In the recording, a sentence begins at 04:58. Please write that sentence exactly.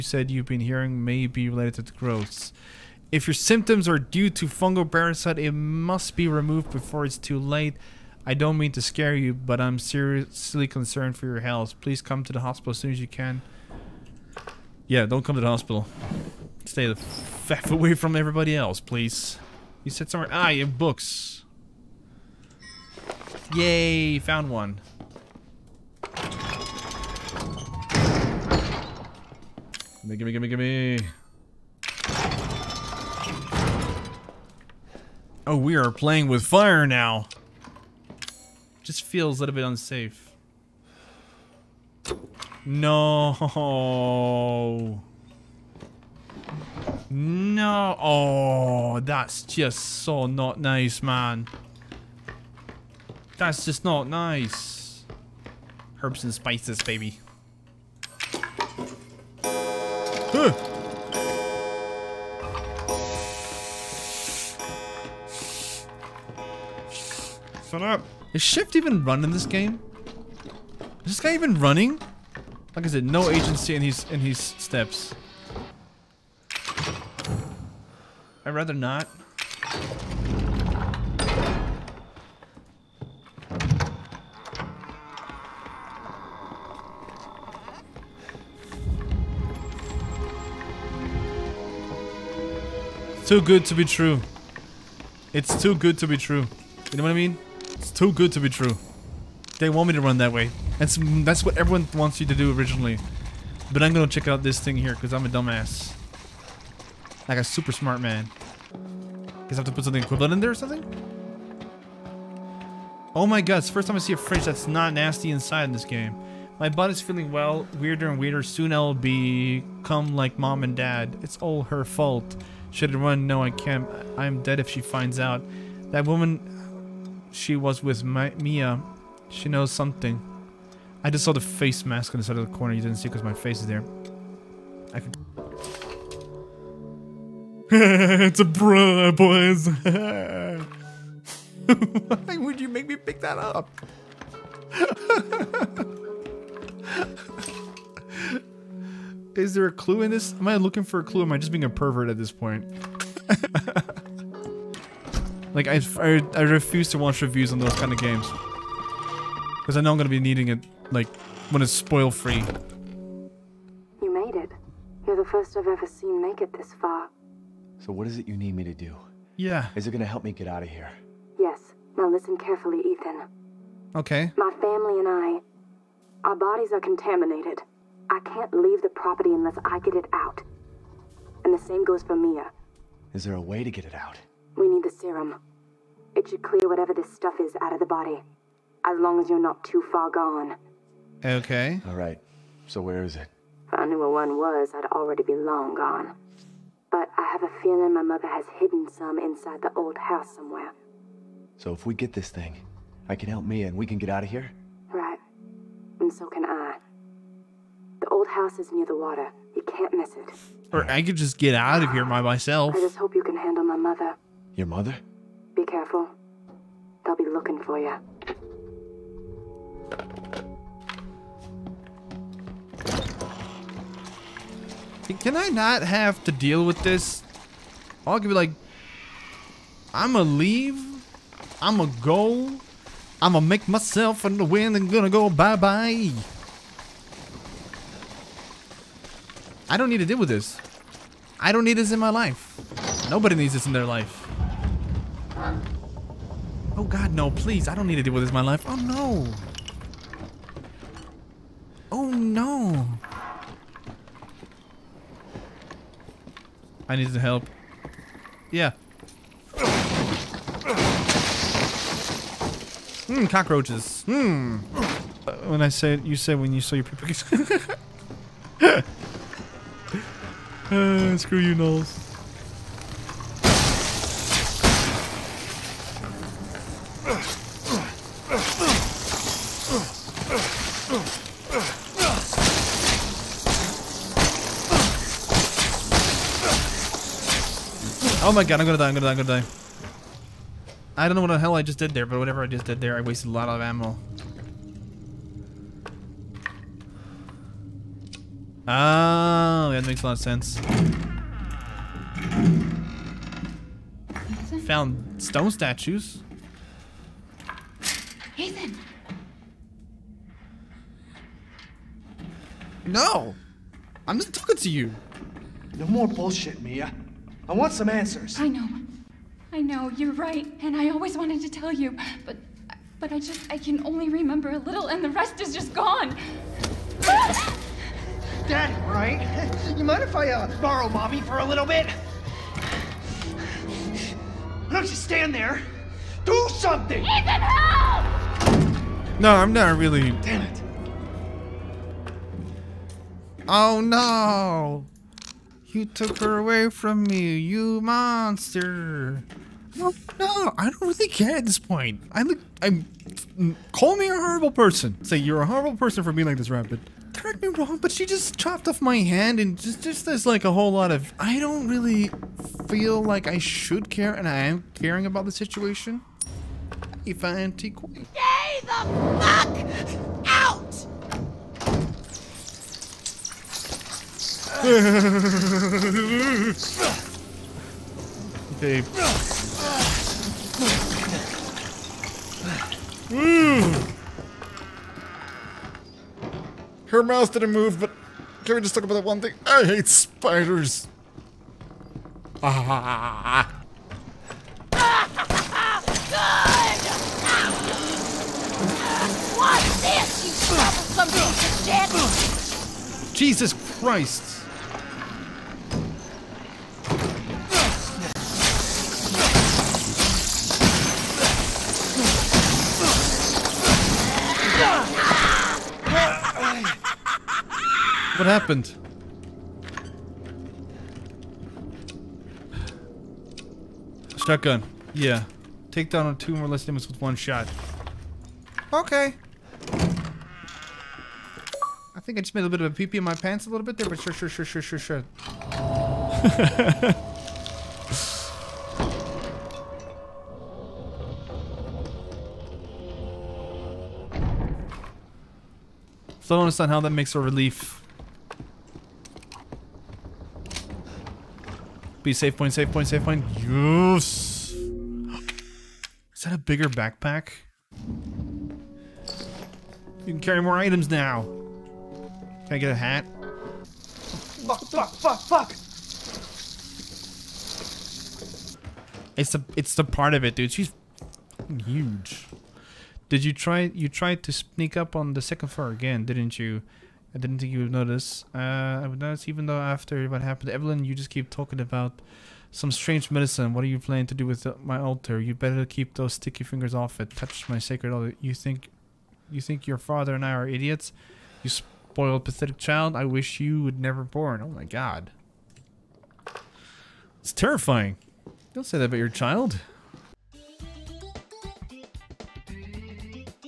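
Oh, that makes a lot of sense.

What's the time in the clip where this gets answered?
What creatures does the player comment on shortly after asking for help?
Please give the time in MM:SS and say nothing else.
04:23.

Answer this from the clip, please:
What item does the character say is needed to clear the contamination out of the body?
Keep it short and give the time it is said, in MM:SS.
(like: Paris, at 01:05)
The serum, at 03:04.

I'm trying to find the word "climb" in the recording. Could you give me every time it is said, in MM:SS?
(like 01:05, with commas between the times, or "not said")
not said.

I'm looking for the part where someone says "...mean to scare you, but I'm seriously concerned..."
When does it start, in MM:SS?
00:08.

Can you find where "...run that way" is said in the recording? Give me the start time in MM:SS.
01:40.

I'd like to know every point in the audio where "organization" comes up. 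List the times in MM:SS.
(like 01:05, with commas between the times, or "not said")
not said.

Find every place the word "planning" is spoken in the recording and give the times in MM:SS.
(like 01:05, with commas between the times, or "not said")
08:03.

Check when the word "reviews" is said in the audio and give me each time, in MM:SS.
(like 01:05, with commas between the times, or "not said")
02:37.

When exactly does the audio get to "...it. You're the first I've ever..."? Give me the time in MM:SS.
02:44.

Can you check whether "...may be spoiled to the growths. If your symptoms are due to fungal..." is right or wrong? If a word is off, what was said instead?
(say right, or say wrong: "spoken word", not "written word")
wrong: "related", not "spoiled".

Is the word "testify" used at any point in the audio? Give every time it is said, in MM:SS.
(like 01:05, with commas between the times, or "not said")
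not said.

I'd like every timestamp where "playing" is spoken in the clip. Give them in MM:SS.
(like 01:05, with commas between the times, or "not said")
00:35.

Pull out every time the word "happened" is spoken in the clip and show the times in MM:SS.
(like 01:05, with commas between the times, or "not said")
06:58, 08:00.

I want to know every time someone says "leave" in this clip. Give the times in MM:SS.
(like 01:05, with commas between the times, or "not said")
02:58, 03:50.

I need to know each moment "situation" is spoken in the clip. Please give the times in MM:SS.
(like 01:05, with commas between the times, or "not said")
06:05.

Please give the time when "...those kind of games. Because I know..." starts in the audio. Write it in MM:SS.
02:37.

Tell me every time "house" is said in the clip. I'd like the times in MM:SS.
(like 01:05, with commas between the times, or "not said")
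03:19, 03:28.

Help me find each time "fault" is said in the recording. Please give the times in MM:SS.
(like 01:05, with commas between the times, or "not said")
02:01.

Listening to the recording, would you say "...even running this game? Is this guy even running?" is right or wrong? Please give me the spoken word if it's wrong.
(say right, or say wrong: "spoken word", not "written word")
right.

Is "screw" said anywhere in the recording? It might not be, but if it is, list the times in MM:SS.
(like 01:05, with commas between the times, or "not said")
04:31.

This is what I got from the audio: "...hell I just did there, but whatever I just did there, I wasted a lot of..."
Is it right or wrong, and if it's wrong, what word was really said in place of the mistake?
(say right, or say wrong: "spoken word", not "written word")
right.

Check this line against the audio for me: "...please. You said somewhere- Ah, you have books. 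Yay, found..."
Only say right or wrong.
right.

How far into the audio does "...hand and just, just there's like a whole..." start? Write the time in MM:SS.
05:58.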